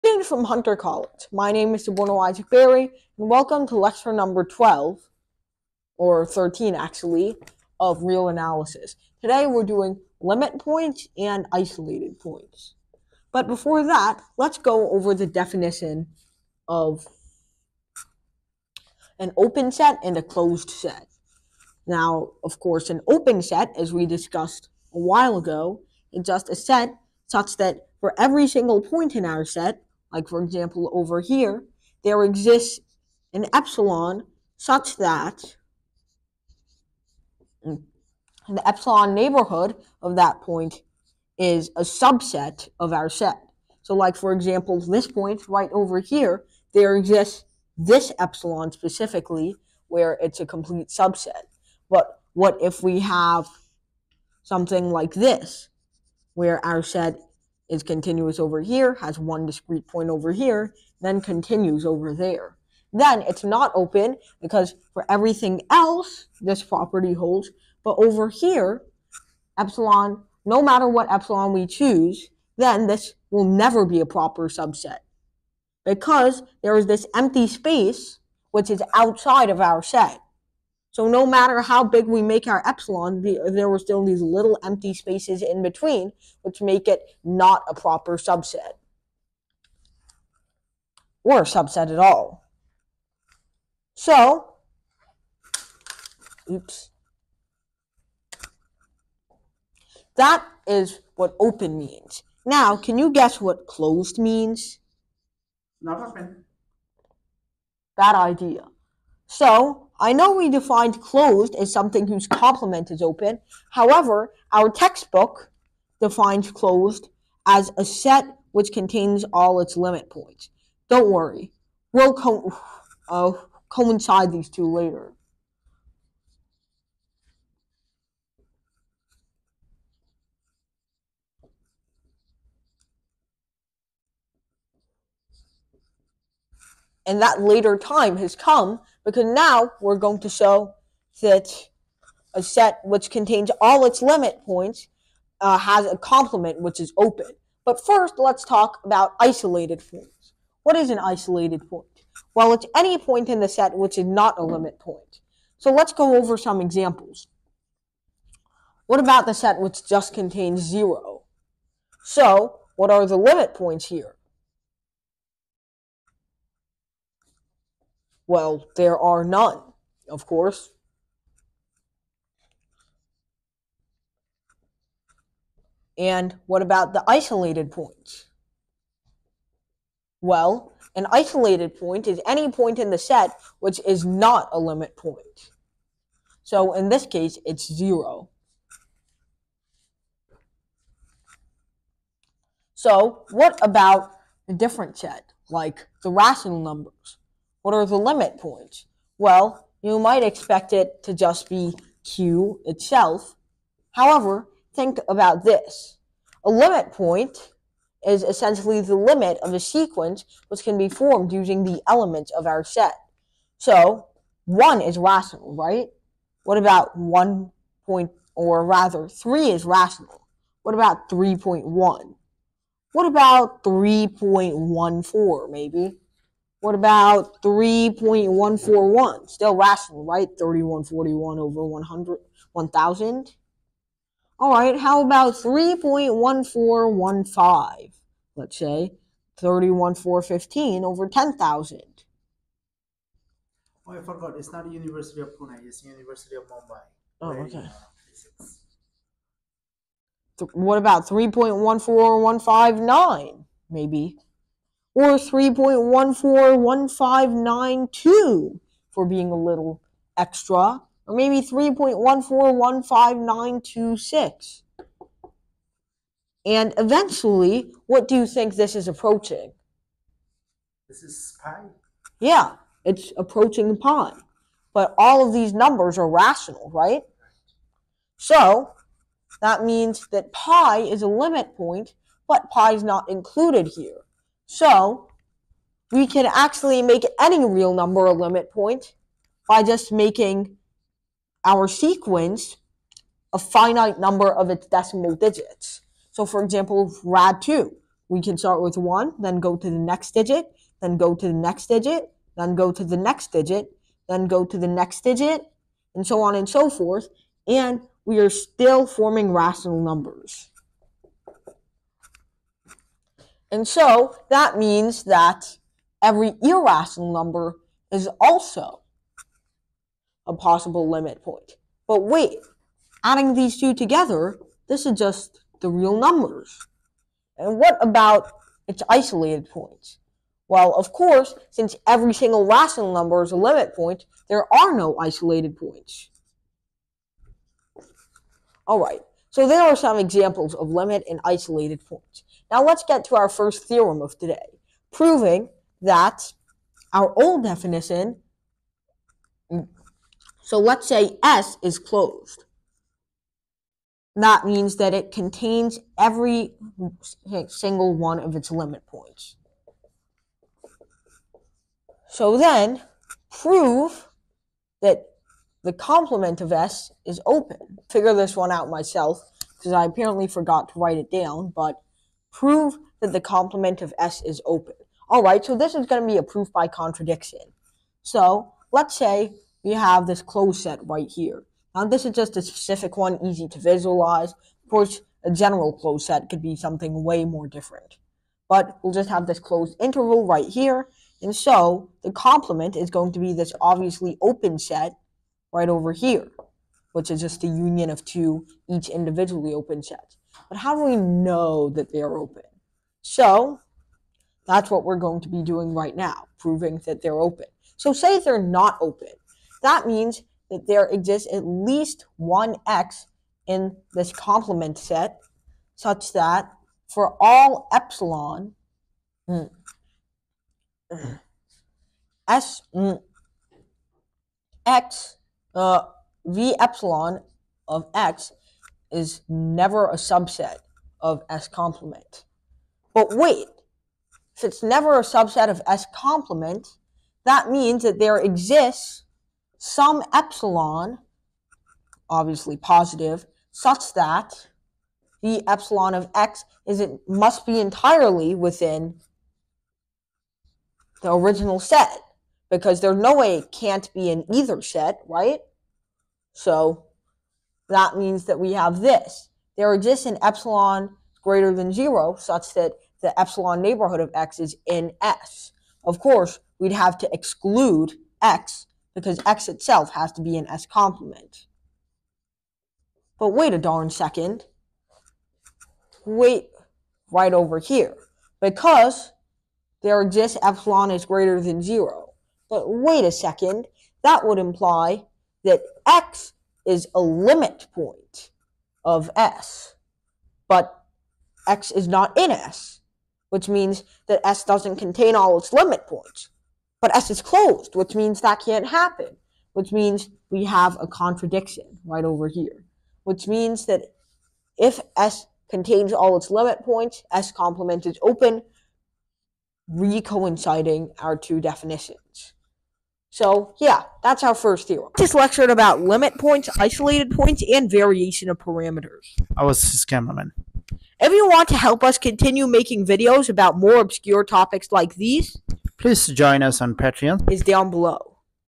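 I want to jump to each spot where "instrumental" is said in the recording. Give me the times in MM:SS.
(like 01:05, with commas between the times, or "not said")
not said.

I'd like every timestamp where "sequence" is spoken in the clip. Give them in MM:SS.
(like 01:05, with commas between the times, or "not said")
03:29, 04:51.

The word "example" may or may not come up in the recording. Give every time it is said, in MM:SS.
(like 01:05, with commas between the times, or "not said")
00:30, 00:44, 02:36, 04:56, 05:39.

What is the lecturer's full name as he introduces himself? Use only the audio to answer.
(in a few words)
Suborno Isaac Bari.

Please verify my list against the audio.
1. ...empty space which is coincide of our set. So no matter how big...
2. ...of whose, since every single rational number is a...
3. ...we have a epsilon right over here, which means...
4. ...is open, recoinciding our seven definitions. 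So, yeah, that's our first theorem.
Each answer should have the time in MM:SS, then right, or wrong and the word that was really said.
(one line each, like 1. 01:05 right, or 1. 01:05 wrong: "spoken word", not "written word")
1. 01:17 wrong: "outside", not "coincide"
2. 05:30 wrong: "course", not "whose"
3. 08:20 wrong: "contradiction", not "epsilon"
4. 08:27 wrong: "two", not "seven".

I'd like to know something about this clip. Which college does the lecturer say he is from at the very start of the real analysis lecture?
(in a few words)
Hunter College.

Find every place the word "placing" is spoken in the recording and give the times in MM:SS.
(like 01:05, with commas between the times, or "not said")
not said.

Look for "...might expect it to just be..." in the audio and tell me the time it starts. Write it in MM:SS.
03:19.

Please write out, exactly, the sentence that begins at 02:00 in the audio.
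Don't worry, we'll co uh, coincide these two later.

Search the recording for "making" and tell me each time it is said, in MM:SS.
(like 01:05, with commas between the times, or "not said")
04:49, 08:42.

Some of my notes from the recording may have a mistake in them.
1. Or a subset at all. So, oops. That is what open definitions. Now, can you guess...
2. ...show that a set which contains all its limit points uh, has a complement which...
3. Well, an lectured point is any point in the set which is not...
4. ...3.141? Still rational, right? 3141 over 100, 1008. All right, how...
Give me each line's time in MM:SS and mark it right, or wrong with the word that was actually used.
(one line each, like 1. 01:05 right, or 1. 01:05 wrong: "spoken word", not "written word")
1. 01:31 wrong: "means", not "definitions"
2. 02:20 right
3. 03:00 wrong: "isolated", not "lectured"
4. 03:47 wrong: "1000", not "1008".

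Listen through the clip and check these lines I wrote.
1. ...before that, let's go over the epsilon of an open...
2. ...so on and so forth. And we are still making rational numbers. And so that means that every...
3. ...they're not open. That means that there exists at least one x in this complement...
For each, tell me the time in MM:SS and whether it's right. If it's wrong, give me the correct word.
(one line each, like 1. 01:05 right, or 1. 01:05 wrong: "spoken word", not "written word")
1. 00:13 wrong: "definition", not "epsilon"
2. 05:06 wrong: "forming", not "making"
3. 06:48 right.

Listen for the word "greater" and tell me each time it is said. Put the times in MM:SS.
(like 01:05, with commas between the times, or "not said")
07:41, 08:01.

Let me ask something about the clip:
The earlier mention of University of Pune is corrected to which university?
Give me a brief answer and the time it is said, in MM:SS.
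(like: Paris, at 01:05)
University of Mumbai, at 04:05.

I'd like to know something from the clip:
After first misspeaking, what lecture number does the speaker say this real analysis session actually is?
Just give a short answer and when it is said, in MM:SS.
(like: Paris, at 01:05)
13, at 00:06.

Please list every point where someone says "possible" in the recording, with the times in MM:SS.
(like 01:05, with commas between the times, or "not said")
05:20.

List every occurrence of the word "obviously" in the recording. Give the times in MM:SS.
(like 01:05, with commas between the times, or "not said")
06:33, 07:22.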